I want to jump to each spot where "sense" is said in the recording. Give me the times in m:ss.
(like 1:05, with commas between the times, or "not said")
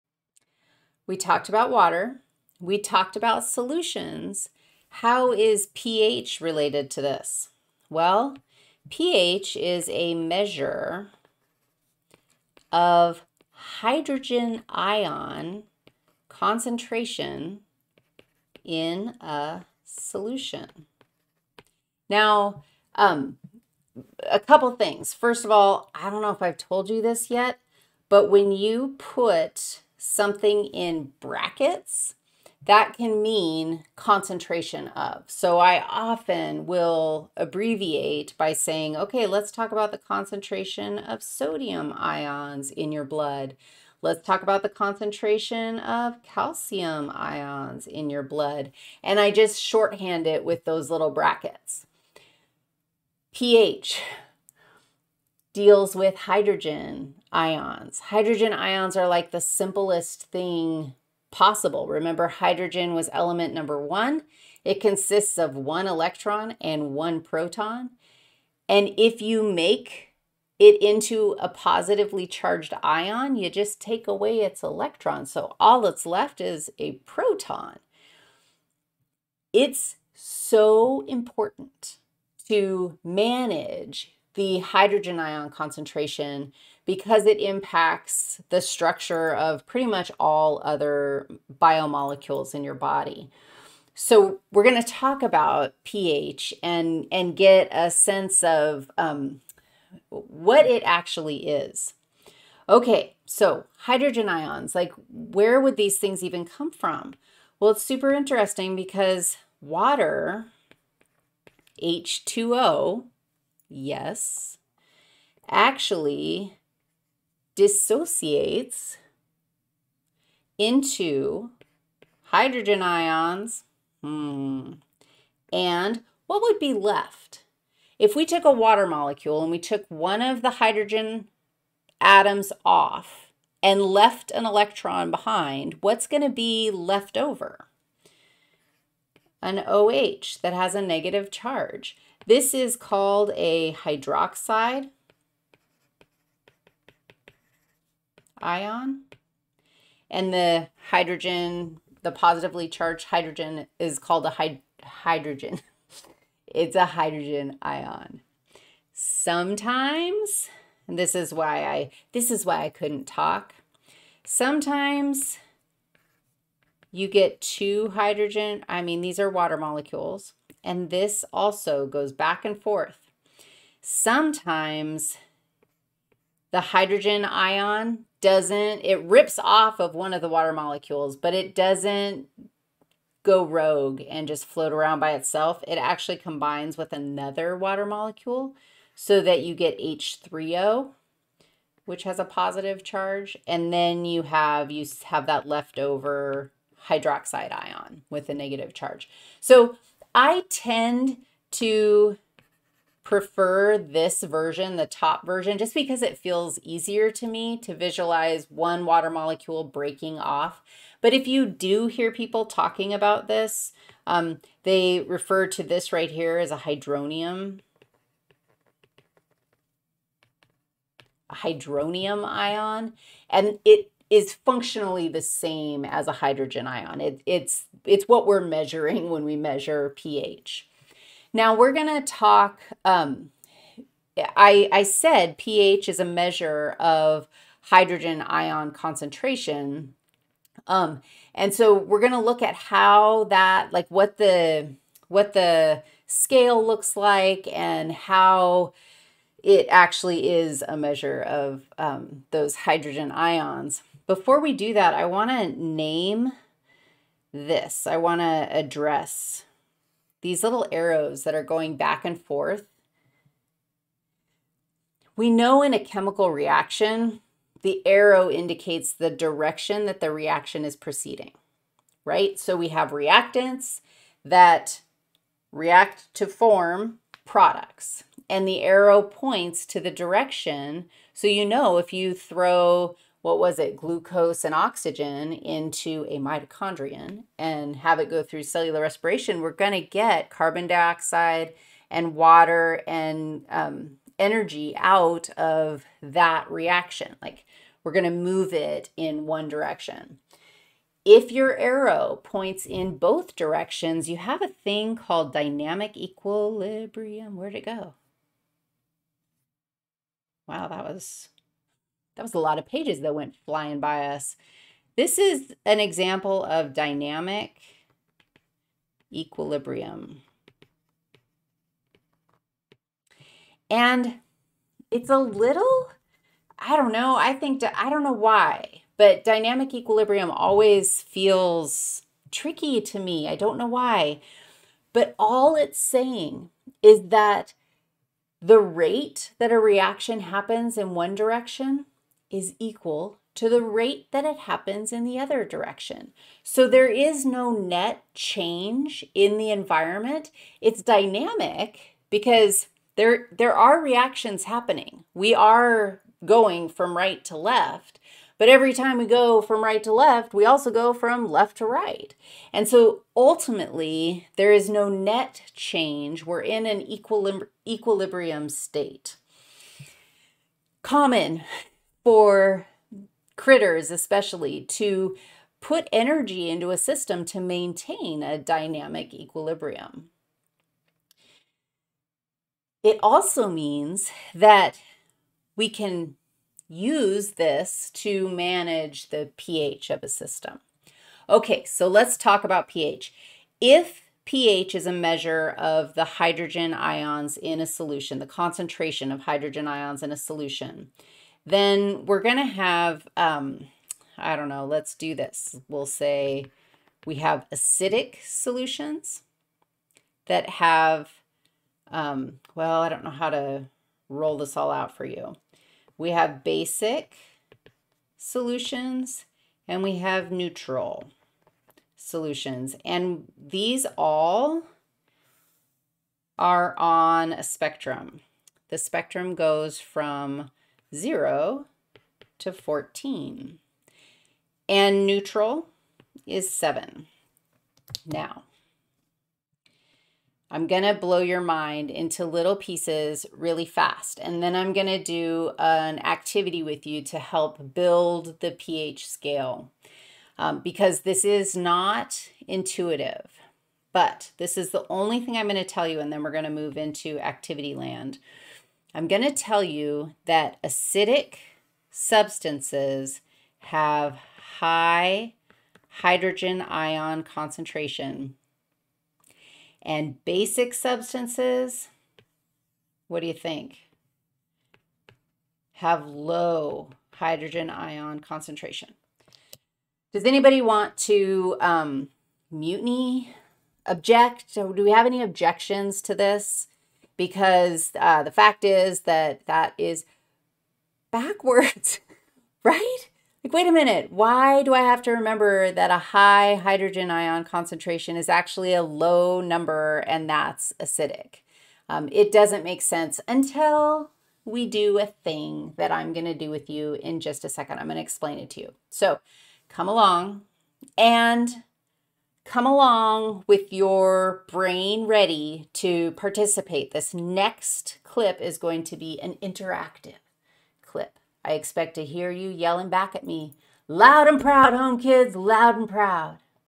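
1:37, 8:22.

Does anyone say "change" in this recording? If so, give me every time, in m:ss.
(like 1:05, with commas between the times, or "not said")
5:48, 6:05.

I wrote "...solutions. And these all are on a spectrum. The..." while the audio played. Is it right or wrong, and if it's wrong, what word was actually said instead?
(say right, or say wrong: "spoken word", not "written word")
right.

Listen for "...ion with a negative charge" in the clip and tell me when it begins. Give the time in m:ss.
3:17.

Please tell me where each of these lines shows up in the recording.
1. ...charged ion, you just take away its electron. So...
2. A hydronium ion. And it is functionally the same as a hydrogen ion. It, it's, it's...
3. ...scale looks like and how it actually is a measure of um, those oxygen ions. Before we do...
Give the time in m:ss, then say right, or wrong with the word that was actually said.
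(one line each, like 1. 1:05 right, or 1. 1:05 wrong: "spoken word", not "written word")
1. 1:12 right
2. 3:41 right
3. 4:06 wrong: "hydrogen", not "oxygen".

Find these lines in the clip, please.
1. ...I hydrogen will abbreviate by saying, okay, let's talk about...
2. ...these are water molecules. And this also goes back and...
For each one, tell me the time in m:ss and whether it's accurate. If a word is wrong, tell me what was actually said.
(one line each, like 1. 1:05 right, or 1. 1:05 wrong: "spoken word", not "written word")
1. 0:35 wrong: "often", not "hydrogen"
2. 2:49 right.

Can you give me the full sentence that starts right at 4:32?
So we have reactants that react to form products, and the arrow points to the direction.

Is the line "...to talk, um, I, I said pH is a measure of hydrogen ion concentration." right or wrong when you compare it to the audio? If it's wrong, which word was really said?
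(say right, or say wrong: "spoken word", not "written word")
right.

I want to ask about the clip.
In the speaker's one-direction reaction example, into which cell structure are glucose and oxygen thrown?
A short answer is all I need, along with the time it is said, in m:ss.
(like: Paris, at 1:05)
mitochondrion, at 4:46.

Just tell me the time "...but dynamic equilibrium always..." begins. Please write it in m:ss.
5:28.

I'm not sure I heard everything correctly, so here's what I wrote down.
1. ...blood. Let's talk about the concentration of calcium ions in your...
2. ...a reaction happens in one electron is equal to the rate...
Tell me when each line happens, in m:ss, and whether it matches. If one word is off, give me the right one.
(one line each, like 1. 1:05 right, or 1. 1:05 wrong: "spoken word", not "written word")
1. 0:43 right
2. 5:39 wrong: "direction", not "electron".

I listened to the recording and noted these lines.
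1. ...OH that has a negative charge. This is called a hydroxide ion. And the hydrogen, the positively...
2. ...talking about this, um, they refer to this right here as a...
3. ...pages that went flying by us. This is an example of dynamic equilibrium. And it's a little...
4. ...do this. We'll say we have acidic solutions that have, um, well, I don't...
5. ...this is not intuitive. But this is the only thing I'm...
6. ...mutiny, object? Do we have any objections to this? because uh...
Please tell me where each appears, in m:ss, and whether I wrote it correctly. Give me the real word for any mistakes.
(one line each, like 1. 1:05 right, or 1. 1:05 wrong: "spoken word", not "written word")
1. 2:19 right
2. 3:32 right
3. 5:12 right
4. 6:44 right
5. 7:31 right
6. 8:02 right.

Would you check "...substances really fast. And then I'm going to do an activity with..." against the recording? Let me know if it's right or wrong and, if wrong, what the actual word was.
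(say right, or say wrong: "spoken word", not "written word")
wrong: "pieces", not "substances".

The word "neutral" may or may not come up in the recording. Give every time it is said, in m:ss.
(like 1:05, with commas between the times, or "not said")
7:00, 7:15.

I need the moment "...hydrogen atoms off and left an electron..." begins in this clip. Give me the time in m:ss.
2:10.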